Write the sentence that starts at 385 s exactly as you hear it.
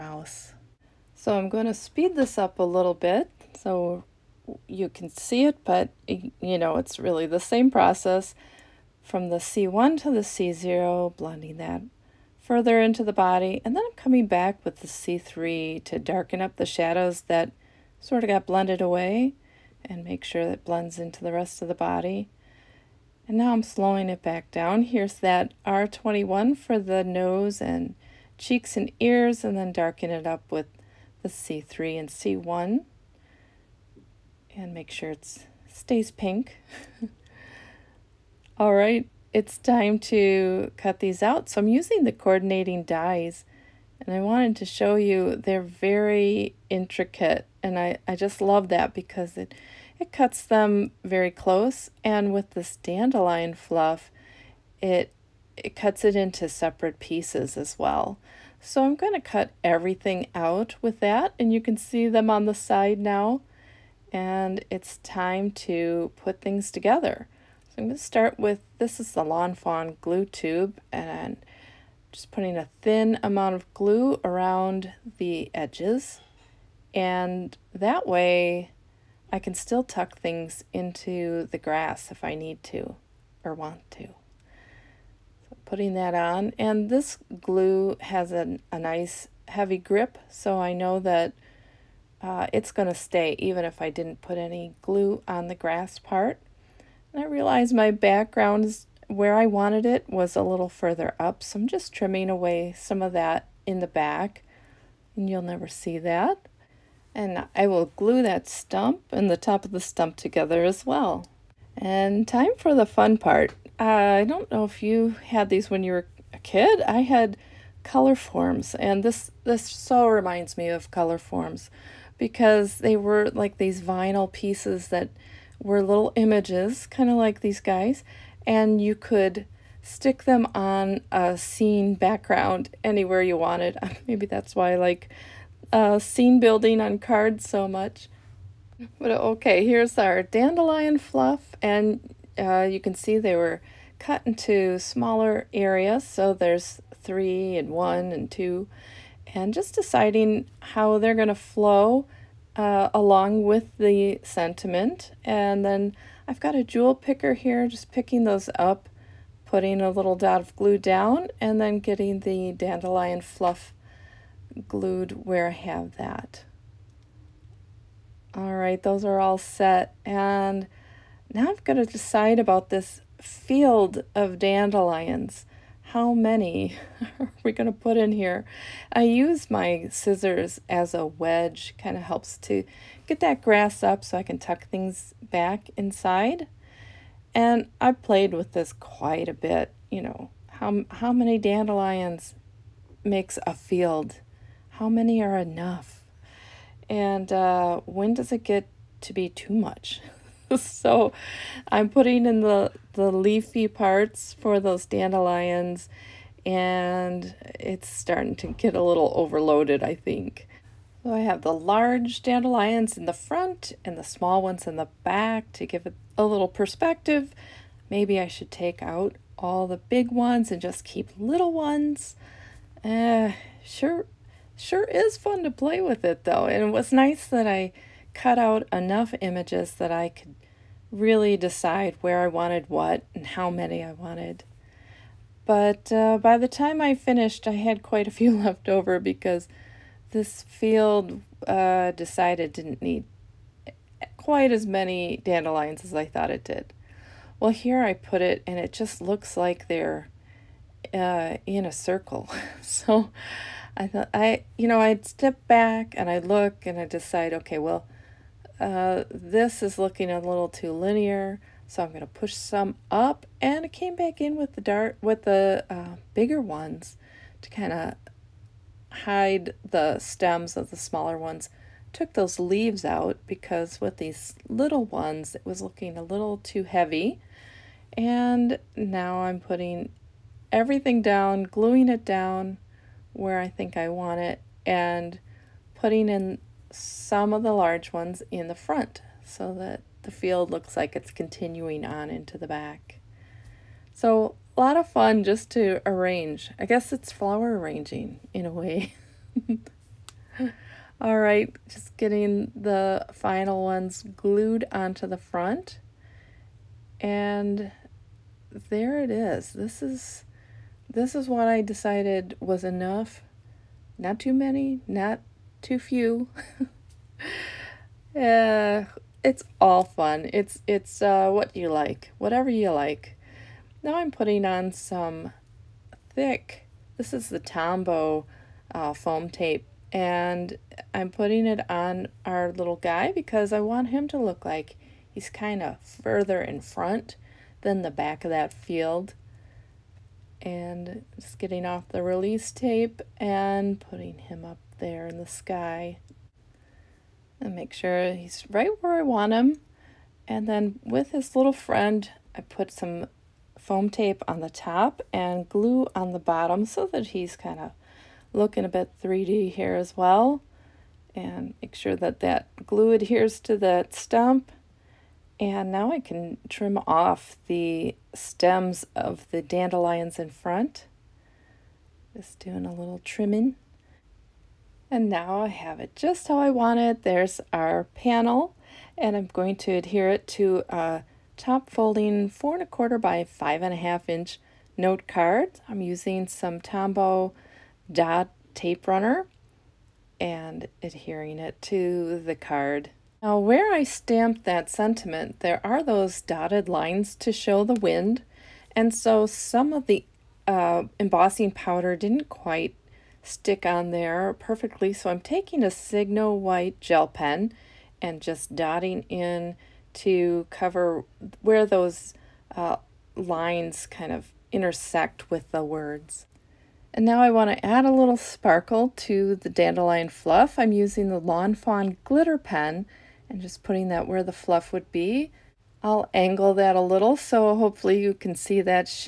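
I'm using some Tombow dot tape runner and adhering it to the card.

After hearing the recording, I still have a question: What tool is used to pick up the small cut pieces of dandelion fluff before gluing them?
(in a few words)
jewel picker.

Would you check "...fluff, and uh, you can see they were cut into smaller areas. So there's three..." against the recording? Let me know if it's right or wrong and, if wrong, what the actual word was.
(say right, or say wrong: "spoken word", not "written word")
right.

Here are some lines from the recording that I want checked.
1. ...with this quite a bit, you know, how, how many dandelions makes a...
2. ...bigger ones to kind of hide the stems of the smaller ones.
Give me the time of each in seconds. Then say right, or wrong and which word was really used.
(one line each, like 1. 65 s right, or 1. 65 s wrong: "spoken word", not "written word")
1. 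188 s right
2. 266 s right.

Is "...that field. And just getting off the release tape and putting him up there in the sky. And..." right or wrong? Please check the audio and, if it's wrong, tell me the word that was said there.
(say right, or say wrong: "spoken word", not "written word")
right.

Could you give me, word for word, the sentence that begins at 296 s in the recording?
I guess it's flower arranging in a way.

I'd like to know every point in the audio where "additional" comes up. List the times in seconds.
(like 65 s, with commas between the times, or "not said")
not said.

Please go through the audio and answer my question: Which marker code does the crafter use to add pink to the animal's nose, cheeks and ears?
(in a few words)
R21.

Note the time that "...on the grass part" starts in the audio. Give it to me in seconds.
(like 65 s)
95 s.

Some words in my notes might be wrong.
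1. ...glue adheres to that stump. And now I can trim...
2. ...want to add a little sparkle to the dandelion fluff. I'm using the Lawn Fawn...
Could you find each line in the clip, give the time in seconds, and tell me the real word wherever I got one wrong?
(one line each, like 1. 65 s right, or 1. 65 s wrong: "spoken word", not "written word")
1. 362 s right
2. 417 s right.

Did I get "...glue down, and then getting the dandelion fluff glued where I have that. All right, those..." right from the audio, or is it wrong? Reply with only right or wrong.
right.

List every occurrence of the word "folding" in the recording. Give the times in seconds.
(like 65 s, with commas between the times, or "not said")
381 s.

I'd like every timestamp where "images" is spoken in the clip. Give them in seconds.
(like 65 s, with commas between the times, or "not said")
126 s, 229 s.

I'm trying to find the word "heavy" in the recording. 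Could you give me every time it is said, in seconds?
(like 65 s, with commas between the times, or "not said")
89 s, 276 s.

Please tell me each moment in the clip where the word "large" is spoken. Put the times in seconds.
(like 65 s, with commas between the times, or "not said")
211 s, 287 s.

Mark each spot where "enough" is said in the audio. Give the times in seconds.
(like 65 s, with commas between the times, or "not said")
195 s, 228 s, 312 s.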